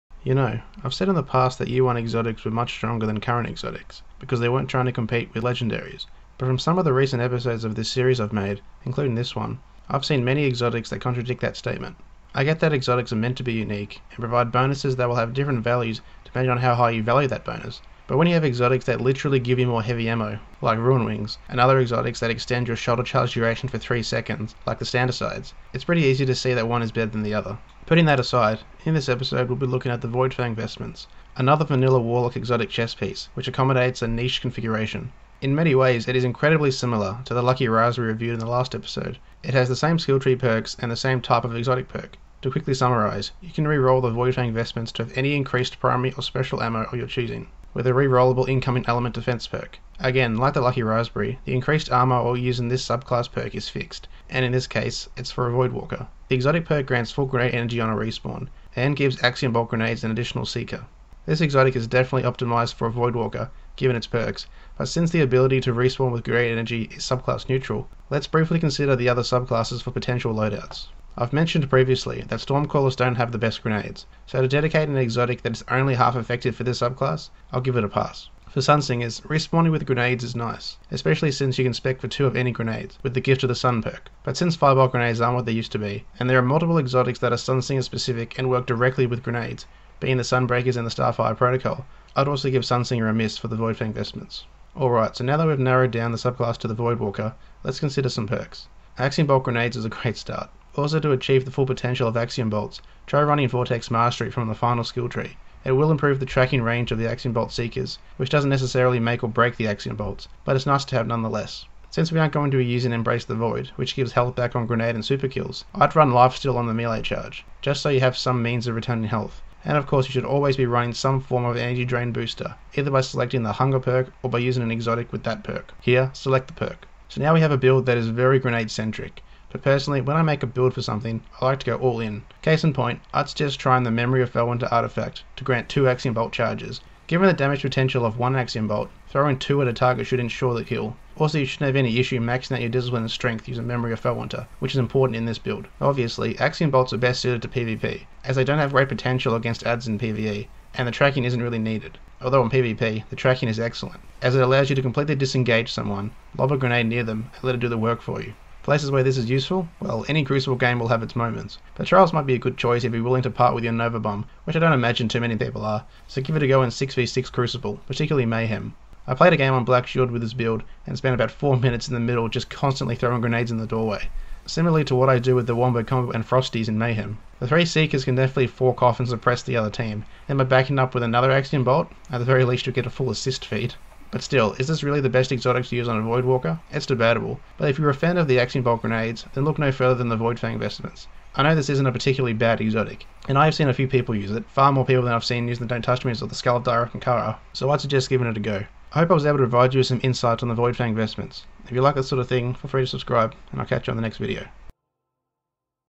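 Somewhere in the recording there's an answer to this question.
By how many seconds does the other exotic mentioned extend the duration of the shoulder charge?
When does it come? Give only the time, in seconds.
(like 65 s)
23 s.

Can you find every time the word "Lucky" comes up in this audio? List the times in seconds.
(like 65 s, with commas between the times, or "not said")
37 s, 50 s.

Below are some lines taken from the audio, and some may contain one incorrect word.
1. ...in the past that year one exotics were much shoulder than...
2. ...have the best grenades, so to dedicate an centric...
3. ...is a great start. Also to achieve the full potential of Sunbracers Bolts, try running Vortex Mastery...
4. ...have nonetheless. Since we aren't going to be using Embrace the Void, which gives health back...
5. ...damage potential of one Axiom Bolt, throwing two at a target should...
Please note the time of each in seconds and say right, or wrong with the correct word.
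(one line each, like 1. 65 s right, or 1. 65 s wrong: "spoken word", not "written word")
1. 1 s wrong: "stronger", not "shoulder"
2. 73 s wrong: "exotic", not "centric"
3. 99 s wrong: "Axiom", not "Sunbracers"
4. 110 s right
5. 137 s right.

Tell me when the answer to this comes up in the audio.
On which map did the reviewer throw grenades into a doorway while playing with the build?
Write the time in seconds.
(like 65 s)
169 s.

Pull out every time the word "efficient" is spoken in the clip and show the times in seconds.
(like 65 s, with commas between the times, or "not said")
not said.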